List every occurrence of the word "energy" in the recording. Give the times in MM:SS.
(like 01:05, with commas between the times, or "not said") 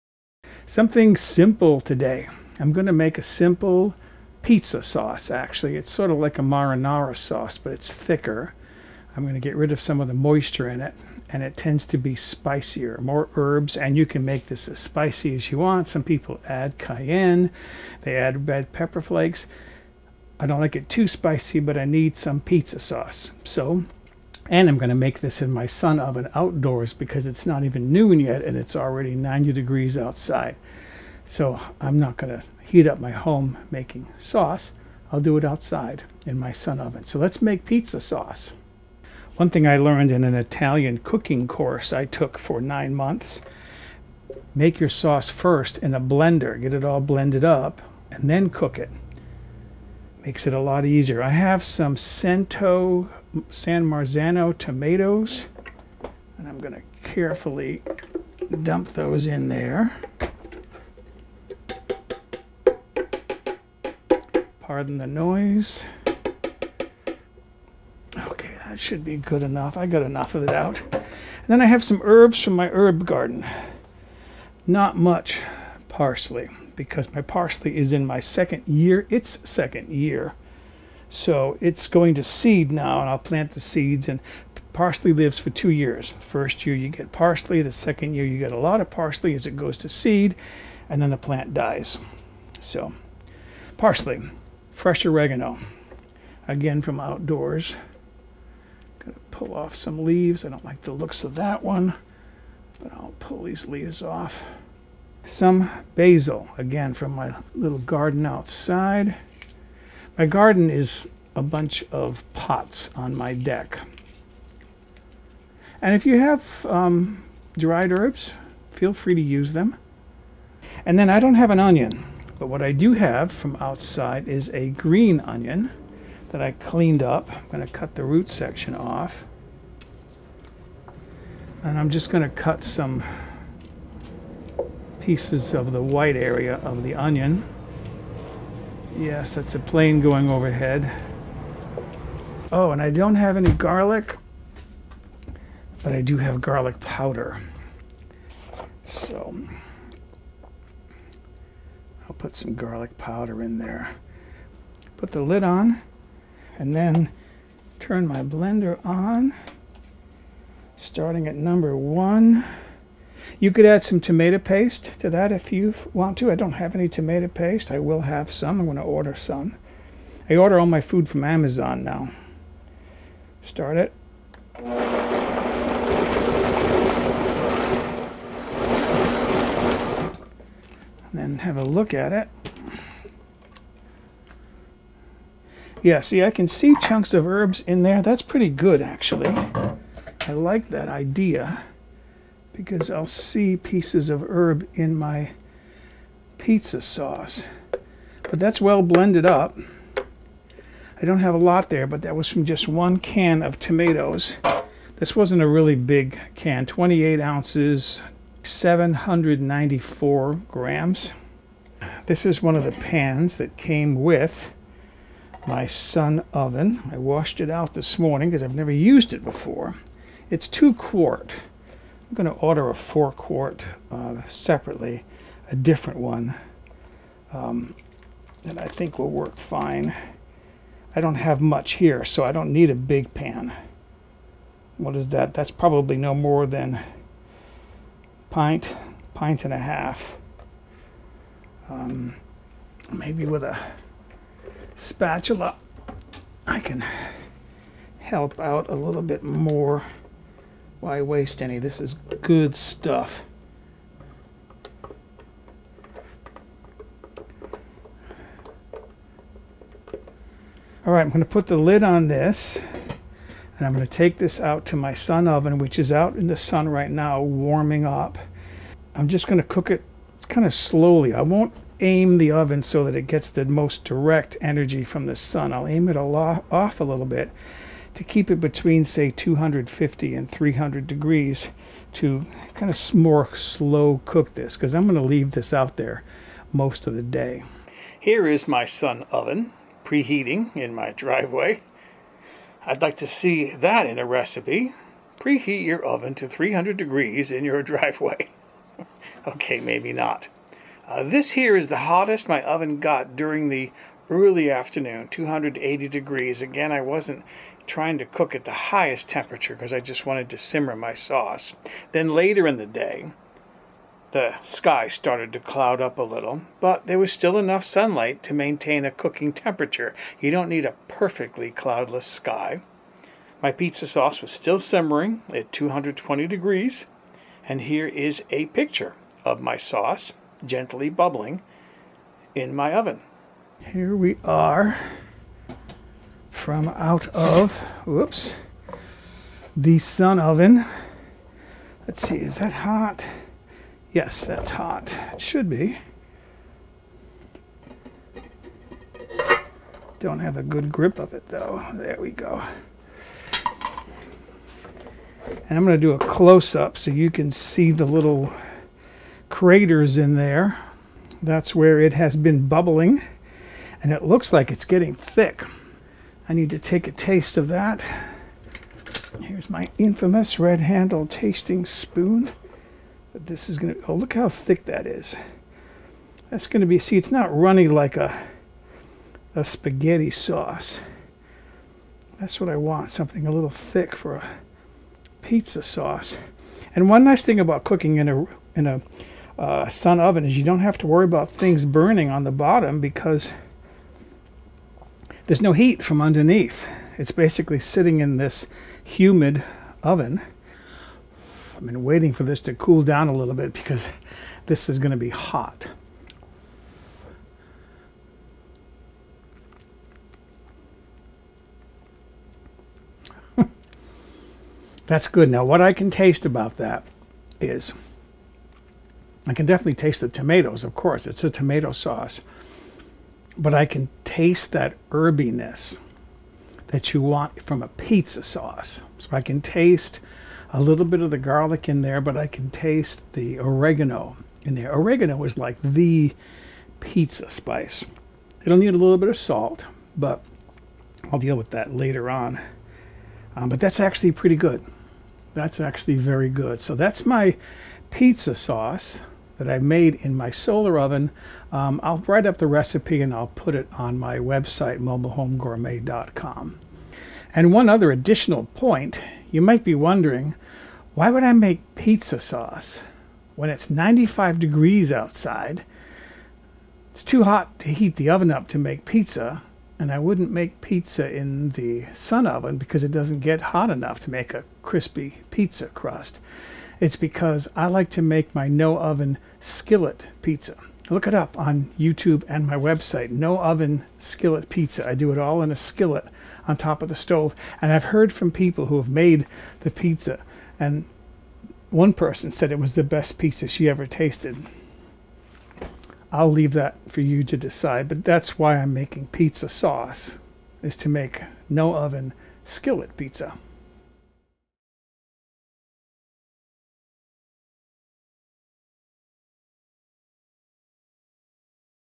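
04:34.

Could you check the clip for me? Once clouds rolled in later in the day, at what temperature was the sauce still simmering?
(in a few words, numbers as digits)
220 degrees.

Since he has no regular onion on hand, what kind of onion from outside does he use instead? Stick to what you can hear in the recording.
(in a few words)
green onion.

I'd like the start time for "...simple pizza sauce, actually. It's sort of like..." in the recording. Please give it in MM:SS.
00:03.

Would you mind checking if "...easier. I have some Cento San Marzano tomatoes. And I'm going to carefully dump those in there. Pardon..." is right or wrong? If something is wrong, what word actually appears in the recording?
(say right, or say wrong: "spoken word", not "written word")
right.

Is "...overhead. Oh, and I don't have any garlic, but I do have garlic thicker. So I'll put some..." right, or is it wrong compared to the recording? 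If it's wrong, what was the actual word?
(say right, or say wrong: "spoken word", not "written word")
wrong: "powder", not "thicker".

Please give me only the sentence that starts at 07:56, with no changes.
It's because I like to make my no oven skillet pizza.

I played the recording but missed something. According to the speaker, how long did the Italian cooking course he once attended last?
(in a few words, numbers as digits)
9 months.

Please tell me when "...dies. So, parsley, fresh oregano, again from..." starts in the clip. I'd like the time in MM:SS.
01:31.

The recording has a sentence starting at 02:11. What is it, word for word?
And I'm just going to cut some pieces of the white area of the onion.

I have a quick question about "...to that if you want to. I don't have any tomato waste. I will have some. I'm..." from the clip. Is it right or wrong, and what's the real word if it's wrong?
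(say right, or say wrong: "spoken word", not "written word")
wrong: "paste", not "waste".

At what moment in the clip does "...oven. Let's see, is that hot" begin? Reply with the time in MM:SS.
05:40.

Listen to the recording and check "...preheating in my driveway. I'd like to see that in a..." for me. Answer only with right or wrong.
right.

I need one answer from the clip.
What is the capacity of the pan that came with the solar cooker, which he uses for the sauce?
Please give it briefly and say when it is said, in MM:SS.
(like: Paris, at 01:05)
2 quart, at 03:40.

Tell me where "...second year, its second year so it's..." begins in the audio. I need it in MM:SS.
01:18.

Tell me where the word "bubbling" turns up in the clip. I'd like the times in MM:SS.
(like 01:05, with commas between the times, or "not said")
05:30, 06:02.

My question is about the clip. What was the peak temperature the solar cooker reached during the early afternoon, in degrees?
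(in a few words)
280 degrees.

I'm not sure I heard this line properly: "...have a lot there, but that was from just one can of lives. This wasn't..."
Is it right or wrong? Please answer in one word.
wrong.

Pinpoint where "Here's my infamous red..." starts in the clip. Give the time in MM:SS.
06:09.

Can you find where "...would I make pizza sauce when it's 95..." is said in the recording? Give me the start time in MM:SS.
07:41.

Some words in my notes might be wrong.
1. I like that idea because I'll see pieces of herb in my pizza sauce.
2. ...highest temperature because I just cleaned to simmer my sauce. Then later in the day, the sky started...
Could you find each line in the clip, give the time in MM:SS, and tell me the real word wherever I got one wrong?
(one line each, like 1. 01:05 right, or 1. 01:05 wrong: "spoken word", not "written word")
1. 03:10 right
2. 05:08 wrong: "wanted", not "cleaned".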